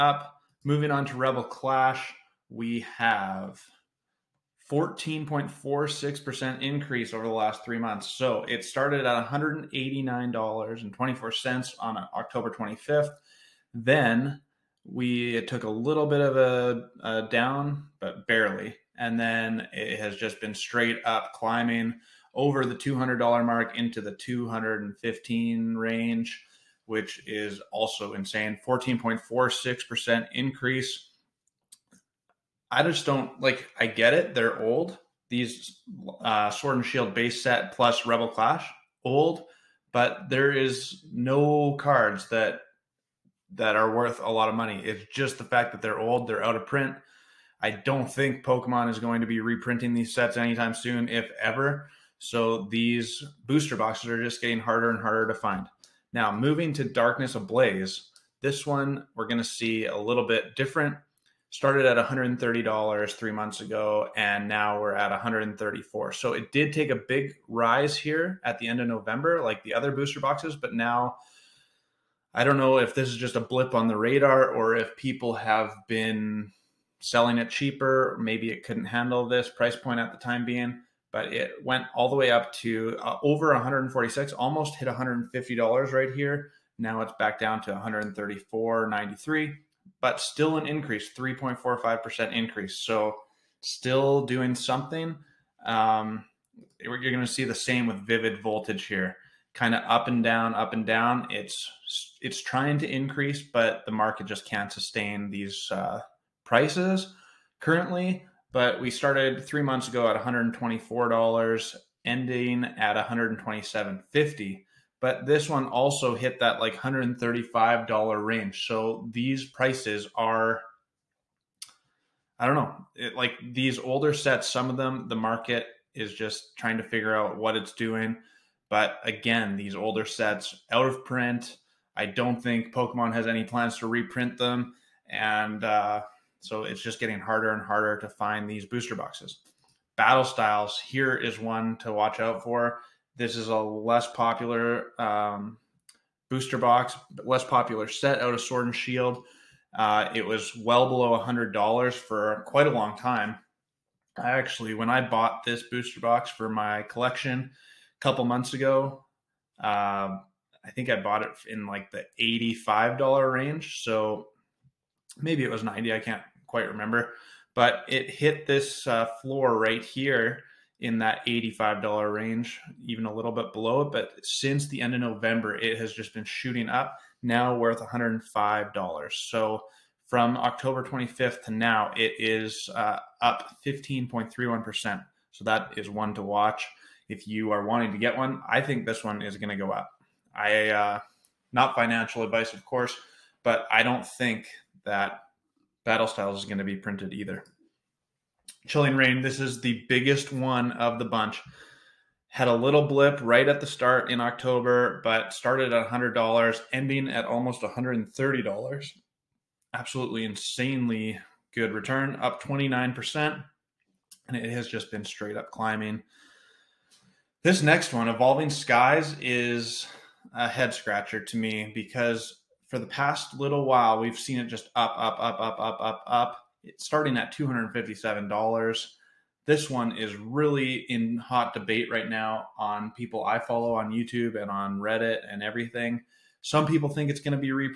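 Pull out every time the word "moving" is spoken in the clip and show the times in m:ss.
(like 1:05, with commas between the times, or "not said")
0:00, 0:56.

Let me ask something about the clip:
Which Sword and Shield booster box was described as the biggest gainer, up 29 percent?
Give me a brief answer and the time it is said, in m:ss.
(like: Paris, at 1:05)
Chilling Reign, at 3:18.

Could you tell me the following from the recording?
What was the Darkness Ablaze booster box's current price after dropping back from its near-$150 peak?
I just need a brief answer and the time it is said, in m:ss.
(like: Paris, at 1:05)
$134.93, at 1:27.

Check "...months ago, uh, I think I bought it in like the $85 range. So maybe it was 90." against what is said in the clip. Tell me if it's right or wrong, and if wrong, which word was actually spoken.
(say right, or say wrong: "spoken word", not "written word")
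right.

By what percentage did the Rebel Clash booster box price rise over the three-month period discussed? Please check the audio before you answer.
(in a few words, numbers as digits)
14.46%.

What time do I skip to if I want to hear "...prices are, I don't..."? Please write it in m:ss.
1:59.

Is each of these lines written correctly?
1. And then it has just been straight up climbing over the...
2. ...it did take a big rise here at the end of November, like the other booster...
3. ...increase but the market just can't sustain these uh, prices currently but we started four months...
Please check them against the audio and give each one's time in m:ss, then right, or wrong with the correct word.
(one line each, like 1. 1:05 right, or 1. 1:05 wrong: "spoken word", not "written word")
1. 0:18 right
2. 1:06 right
3. 1:42 wrong: "three", not "four".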